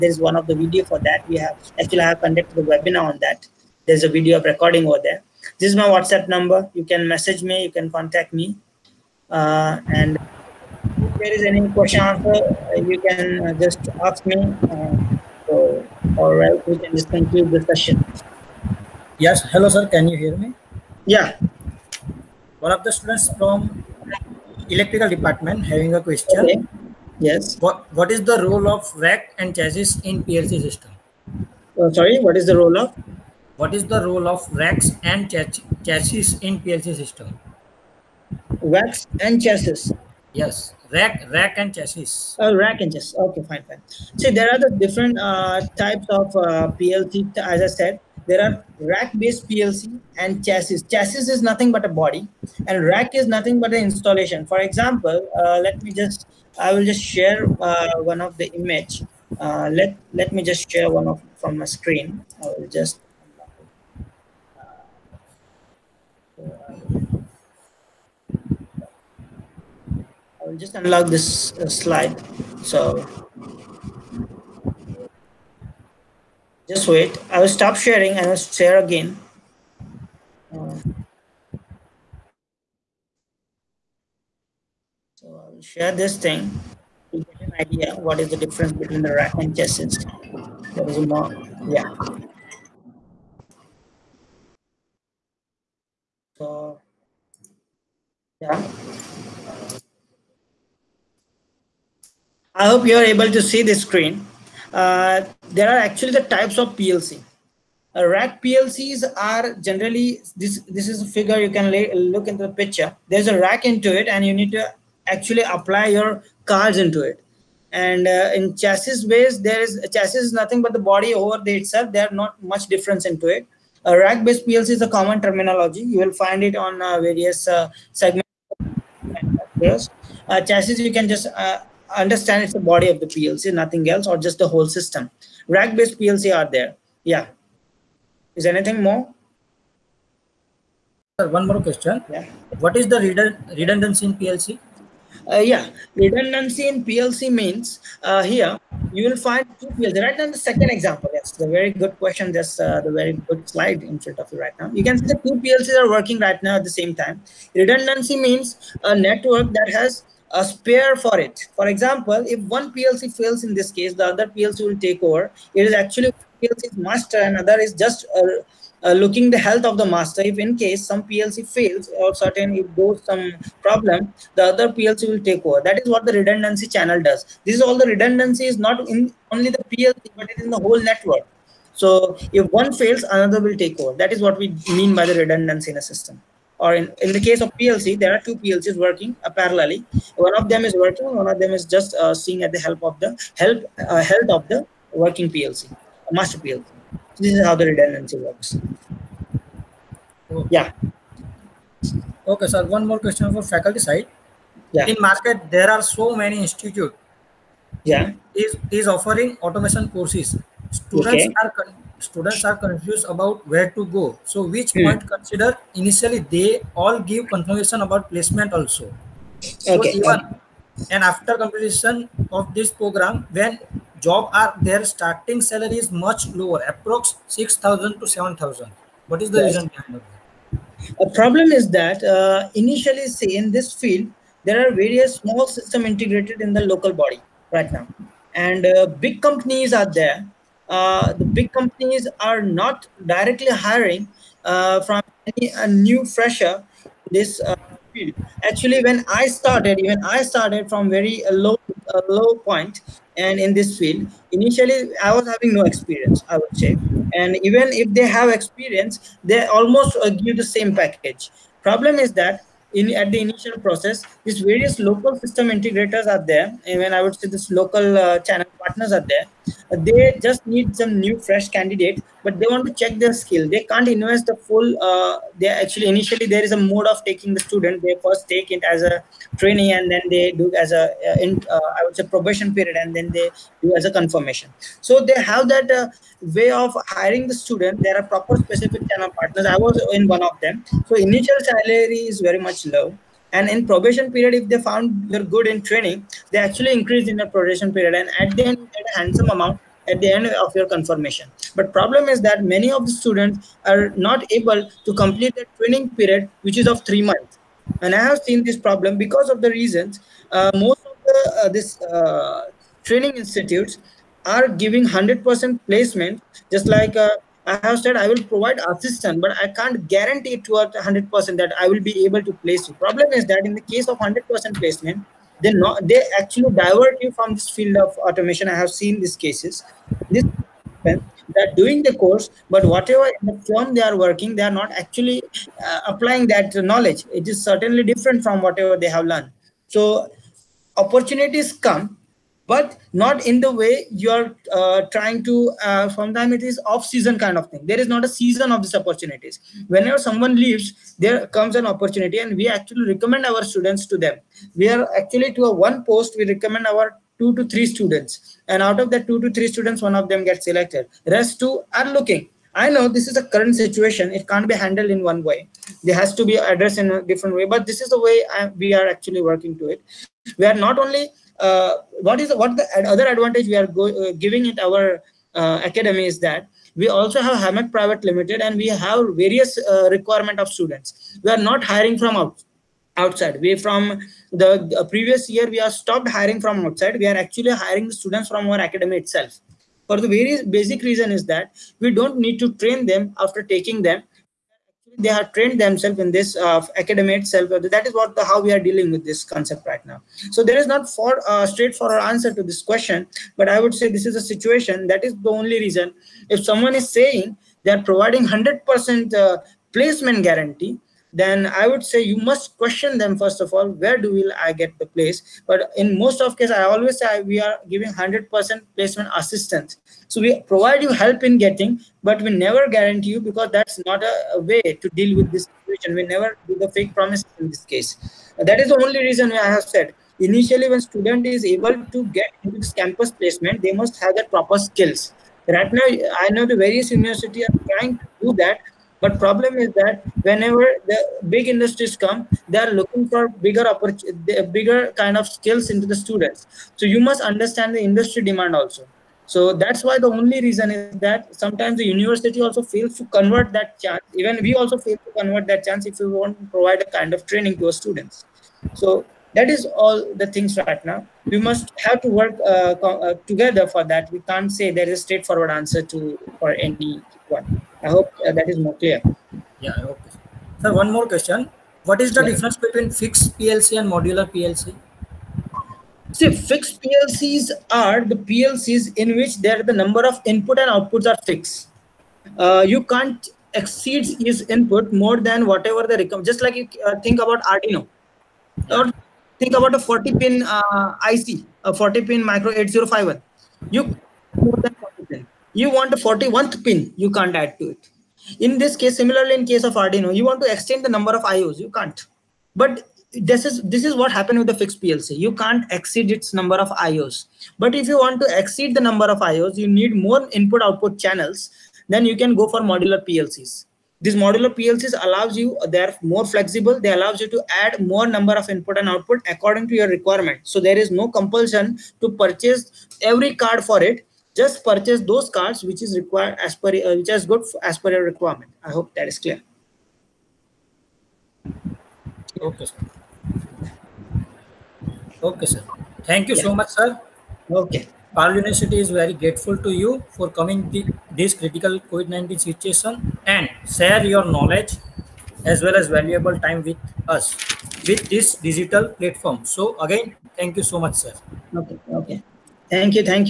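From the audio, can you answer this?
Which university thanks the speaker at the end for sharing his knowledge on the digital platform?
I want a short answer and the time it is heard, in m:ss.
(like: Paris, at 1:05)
Parul University, at 8:58.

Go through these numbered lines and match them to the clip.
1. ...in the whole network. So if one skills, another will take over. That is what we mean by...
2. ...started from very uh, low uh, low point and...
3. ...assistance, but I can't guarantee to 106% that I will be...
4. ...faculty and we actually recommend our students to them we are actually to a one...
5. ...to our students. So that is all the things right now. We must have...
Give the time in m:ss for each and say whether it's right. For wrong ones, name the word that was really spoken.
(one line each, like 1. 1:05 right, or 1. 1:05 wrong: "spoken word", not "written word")
1. 3:00 wrong: "fails", not "skills"
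2. 4:10 right
3. 5:18 wrong: "100", not "106"
4. 5:51 wrong: "opportunity", not "faculty"
5. 7:37 right.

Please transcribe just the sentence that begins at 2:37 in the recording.
Redundancy means a network that has a spare for it.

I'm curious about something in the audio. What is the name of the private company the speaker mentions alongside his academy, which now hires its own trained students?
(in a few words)
Hammett Private Limited.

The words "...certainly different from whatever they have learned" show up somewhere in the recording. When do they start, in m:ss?
5:37.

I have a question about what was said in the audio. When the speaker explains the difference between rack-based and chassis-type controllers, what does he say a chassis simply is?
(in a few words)
a body.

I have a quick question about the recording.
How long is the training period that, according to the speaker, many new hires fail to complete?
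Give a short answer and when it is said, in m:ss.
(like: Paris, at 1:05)
3 months, at 5:06.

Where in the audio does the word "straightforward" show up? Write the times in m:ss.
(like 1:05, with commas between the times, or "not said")
6:41, 7:45.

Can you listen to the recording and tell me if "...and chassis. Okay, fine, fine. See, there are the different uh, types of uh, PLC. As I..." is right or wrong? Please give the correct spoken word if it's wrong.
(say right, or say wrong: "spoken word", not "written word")
right.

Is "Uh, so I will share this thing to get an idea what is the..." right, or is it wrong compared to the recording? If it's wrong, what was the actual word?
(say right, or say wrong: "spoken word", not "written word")
right.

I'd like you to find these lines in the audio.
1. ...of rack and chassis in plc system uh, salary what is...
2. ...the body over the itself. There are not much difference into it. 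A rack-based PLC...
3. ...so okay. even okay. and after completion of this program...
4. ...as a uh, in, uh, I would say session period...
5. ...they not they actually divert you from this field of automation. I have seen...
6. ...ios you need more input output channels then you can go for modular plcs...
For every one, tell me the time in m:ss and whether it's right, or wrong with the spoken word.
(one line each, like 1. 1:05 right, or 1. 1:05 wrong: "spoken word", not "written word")
1. 0:28 wrong: "sorry", not "salary"
2. 2:00 right
3. 3:39 right
4. 4:40 wrong: "probation", not "session"
5. 5:25 right
6. 8:29 right.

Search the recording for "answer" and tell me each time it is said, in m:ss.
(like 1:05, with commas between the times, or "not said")
0:12, 6:42, 7:45.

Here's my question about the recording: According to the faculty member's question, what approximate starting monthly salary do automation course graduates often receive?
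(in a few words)
6000 to 7000.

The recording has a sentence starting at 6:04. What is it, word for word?
It can't be handled in one way.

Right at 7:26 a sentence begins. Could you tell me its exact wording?
So you must understand the industry demand also.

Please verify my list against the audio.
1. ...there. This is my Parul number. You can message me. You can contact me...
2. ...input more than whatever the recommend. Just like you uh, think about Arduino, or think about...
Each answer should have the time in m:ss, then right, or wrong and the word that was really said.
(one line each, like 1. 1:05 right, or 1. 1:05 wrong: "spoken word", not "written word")
1. 0:05 wrong: "WhatsApp", not "Parul"
2. 8:04 right.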